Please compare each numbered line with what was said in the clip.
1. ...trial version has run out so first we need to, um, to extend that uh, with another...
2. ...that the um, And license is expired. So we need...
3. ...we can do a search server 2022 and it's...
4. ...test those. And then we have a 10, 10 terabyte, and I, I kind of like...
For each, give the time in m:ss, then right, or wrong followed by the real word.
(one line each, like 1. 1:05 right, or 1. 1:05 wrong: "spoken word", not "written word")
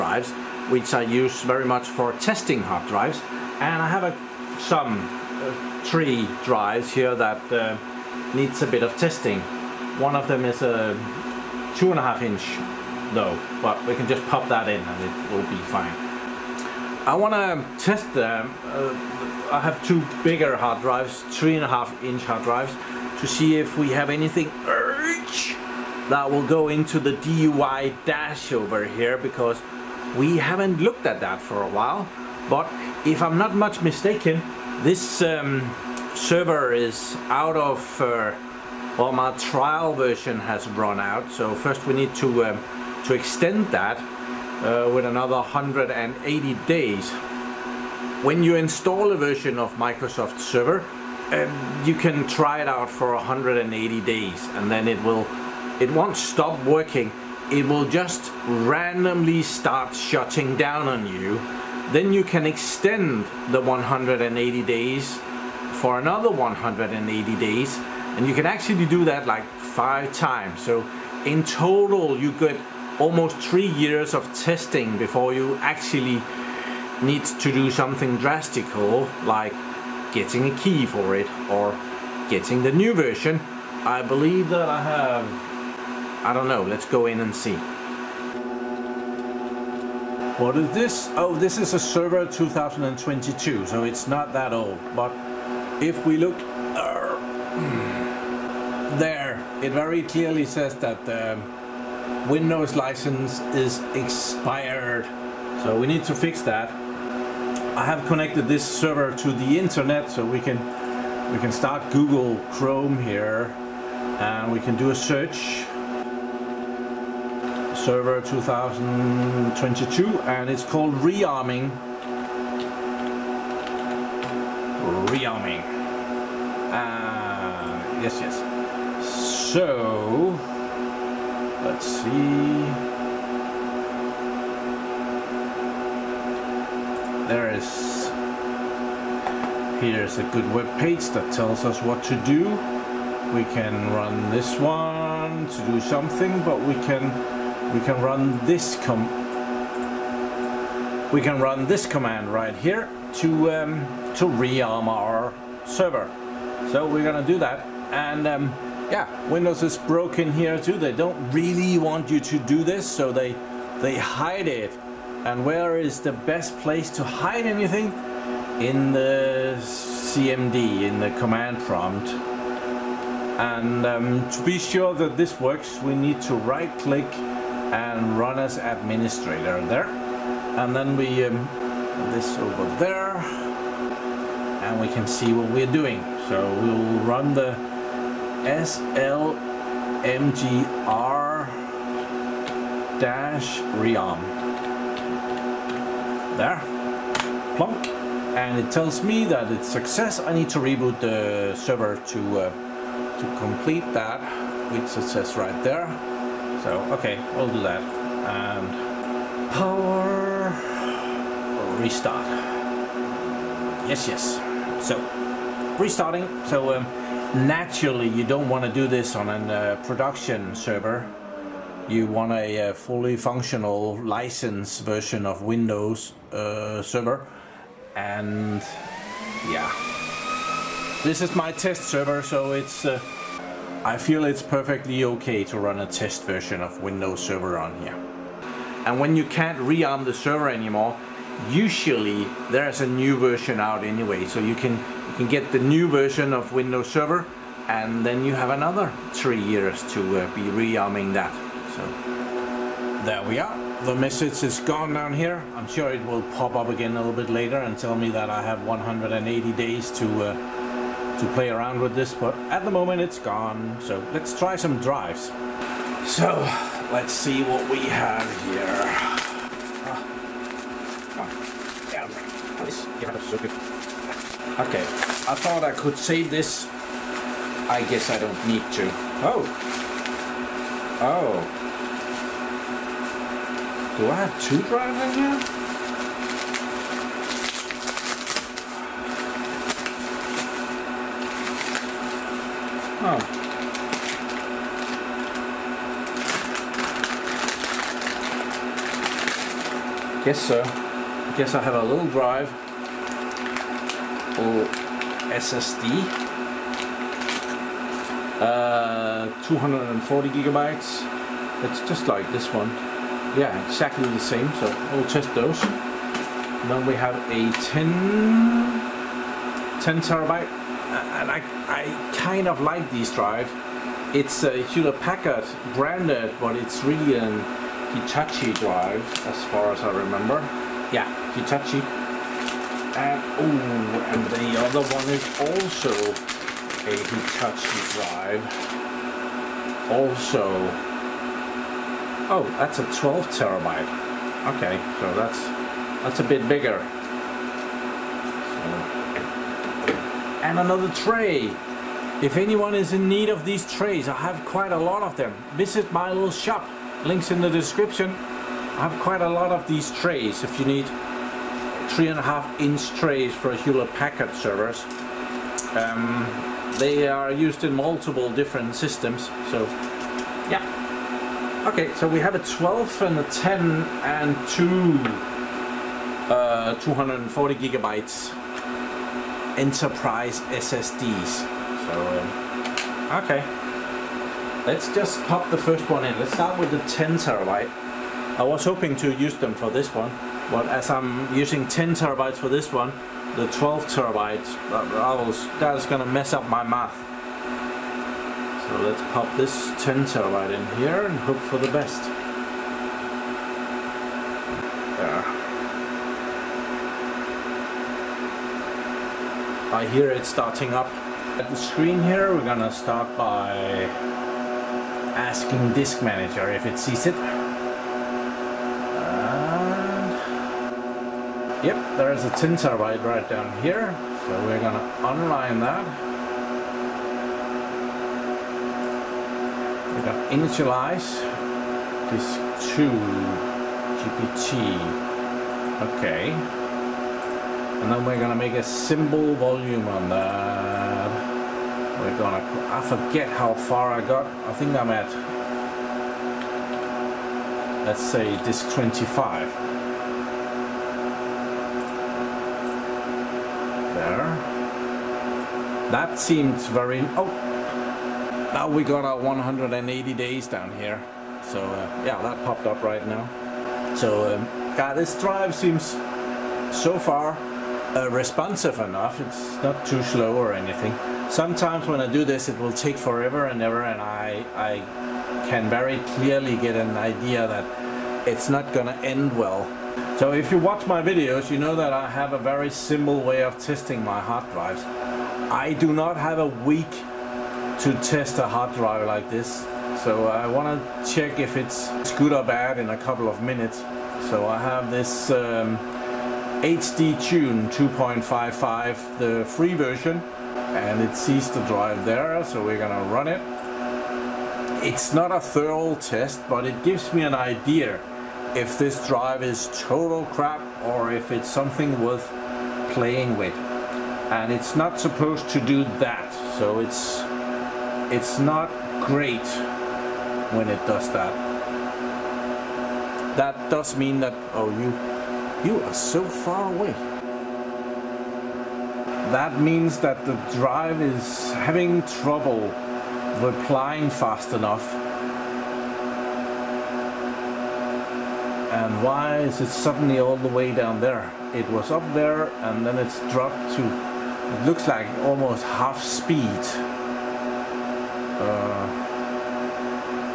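1. 0:39 right
2. 1:40 wrong: "Windows", not "And"
3. 1:54 right
4. 5:15 right.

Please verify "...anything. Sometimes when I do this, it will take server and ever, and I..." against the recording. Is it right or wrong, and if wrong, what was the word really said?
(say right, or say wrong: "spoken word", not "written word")
wrong: "forever", not "server".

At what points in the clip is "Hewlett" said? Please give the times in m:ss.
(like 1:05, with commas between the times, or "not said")
5:24, 6:03.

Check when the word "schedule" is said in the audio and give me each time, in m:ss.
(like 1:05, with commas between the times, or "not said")
not said.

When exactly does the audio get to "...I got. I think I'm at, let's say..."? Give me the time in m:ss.
7:23.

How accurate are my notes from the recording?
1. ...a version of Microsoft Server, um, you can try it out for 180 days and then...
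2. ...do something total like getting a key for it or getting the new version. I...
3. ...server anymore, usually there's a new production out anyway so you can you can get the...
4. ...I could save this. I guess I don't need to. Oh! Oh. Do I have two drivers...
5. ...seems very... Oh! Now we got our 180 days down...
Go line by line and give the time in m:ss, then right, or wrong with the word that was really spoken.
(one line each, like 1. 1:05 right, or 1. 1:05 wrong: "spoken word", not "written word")
1. 0:49 right
2. 1:17 wrong: "drastical", not "total"
3. 4:00 wrong: "version", not "production"
4. 4:35 right
5. 7:36 right.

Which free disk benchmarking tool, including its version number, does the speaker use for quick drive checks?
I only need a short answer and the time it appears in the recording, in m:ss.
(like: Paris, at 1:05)
HD Tune 2.55, at 8:16.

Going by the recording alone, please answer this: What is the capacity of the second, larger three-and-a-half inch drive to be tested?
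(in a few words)
12 TB.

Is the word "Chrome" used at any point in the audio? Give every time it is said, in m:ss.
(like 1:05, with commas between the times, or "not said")
1:52.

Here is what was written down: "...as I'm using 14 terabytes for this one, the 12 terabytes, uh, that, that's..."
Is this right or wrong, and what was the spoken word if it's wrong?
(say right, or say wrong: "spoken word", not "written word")
wrong: "10", not "14".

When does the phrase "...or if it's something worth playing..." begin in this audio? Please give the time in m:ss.
8:30.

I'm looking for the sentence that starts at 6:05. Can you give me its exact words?
Um, they are used in multiple different systems, so yeah.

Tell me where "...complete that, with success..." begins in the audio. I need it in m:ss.
3:23.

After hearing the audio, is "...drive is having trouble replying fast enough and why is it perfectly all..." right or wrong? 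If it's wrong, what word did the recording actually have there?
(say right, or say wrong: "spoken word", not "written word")
wrong: "suddenly", not "perfectly".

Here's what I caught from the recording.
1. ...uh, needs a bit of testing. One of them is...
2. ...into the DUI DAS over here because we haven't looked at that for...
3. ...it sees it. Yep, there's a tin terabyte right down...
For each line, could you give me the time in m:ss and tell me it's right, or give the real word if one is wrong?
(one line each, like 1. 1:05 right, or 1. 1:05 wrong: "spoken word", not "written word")
1. 0:07 right
2. 0:26 right
3. 6:56 right.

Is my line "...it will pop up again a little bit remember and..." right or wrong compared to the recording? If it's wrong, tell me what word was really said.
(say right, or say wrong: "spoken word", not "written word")
wrong: "later", not "remember".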